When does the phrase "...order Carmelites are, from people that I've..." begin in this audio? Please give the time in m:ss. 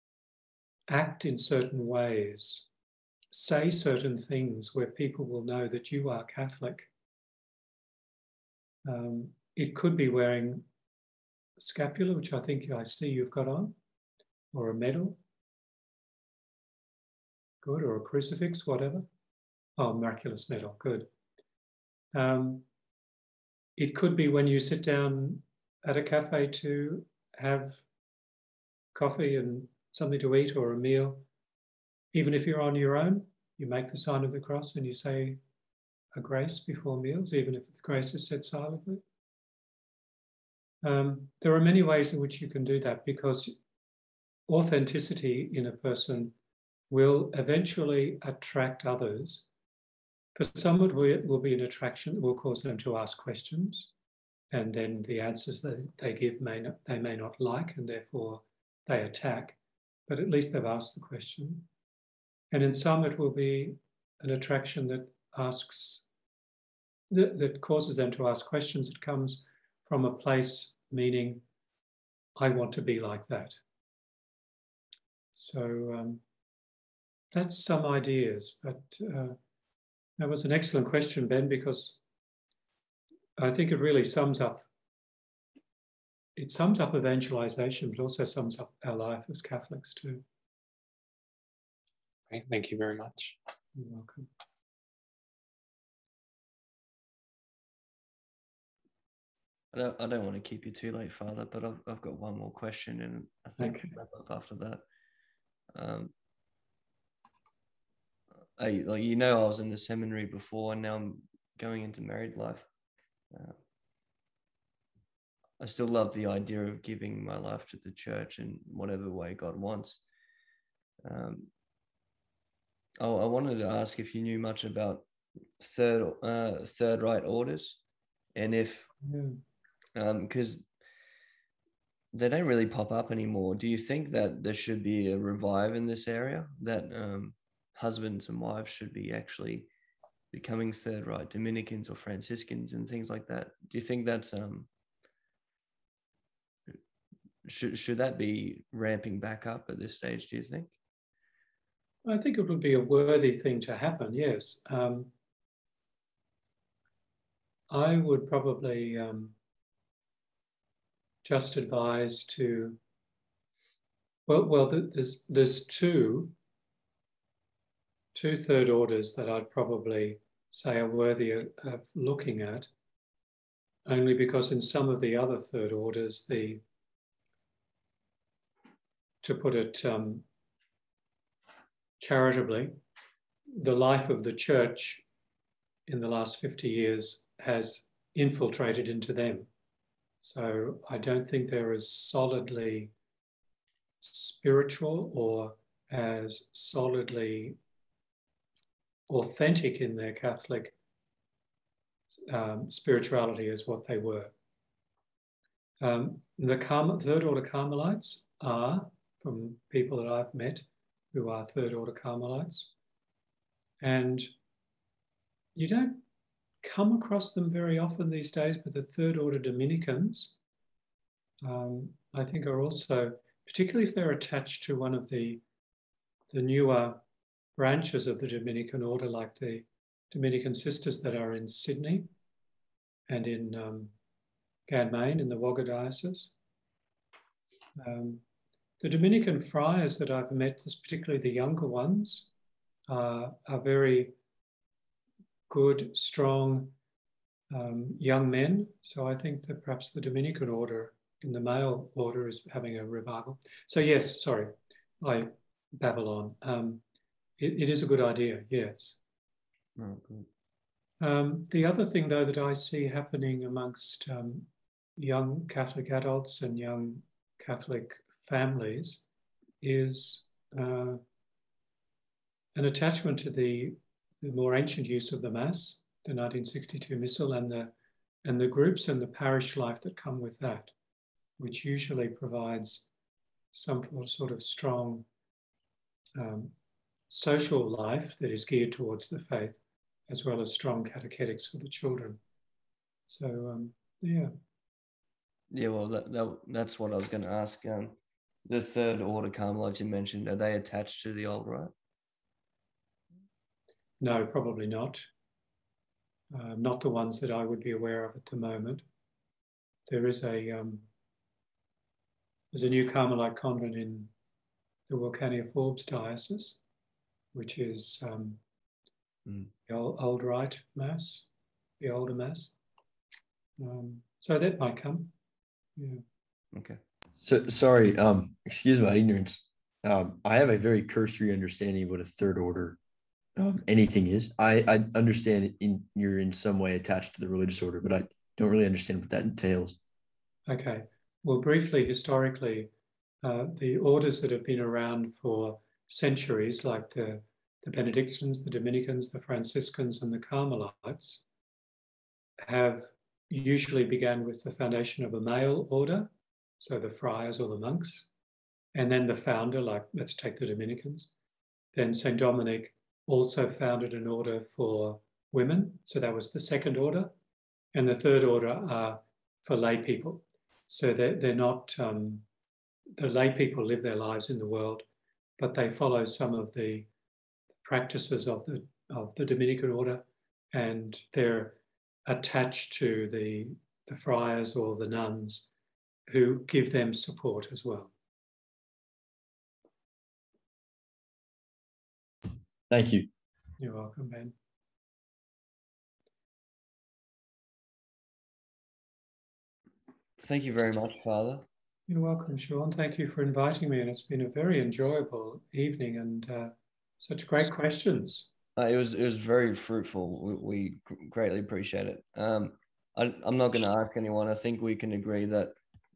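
3:27.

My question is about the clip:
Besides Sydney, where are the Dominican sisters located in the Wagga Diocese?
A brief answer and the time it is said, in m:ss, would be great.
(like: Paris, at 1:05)
Ganmain, at 3:54.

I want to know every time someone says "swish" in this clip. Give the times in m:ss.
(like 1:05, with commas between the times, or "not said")
not said.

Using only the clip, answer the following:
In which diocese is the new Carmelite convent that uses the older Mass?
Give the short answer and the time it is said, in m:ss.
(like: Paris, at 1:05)
Wilcannia Forbes, at 5:14.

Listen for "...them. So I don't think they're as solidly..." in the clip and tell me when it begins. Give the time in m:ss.
3:09.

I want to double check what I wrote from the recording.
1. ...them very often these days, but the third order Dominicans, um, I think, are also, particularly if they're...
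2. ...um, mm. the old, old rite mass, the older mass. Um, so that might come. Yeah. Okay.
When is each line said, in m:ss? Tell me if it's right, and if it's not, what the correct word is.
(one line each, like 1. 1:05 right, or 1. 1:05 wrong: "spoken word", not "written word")
1. 3:37 right
2. 5:18 right.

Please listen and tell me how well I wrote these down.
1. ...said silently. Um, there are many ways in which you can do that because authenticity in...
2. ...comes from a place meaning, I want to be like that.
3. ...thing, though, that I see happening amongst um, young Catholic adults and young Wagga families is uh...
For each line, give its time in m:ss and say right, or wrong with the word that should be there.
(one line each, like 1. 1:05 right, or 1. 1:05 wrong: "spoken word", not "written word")
1. 0:38 right
2. 1:09 right
3. 4:21 wrong: "Catholic", not "Wagga".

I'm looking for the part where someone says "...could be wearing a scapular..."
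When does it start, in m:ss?
0:09.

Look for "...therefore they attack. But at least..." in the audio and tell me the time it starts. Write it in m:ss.
0:57.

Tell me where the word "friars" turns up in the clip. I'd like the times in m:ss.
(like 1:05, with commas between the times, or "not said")
3:59, 5:56, 6:23.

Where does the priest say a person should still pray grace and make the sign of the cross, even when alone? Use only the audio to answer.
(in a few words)
At a cafe.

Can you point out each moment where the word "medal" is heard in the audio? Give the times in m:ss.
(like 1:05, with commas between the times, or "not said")
0:14, 0:20.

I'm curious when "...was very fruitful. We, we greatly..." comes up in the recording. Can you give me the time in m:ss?
6:49.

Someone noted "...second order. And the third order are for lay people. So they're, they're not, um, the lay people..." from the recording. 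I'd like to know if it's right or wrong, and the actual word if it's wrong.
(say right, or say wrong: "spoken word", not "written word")
right.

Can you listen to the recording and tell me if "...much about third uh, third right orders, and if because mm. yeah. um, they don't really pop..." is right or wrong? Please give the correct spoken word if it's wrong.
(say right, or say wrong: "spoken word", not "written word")
right.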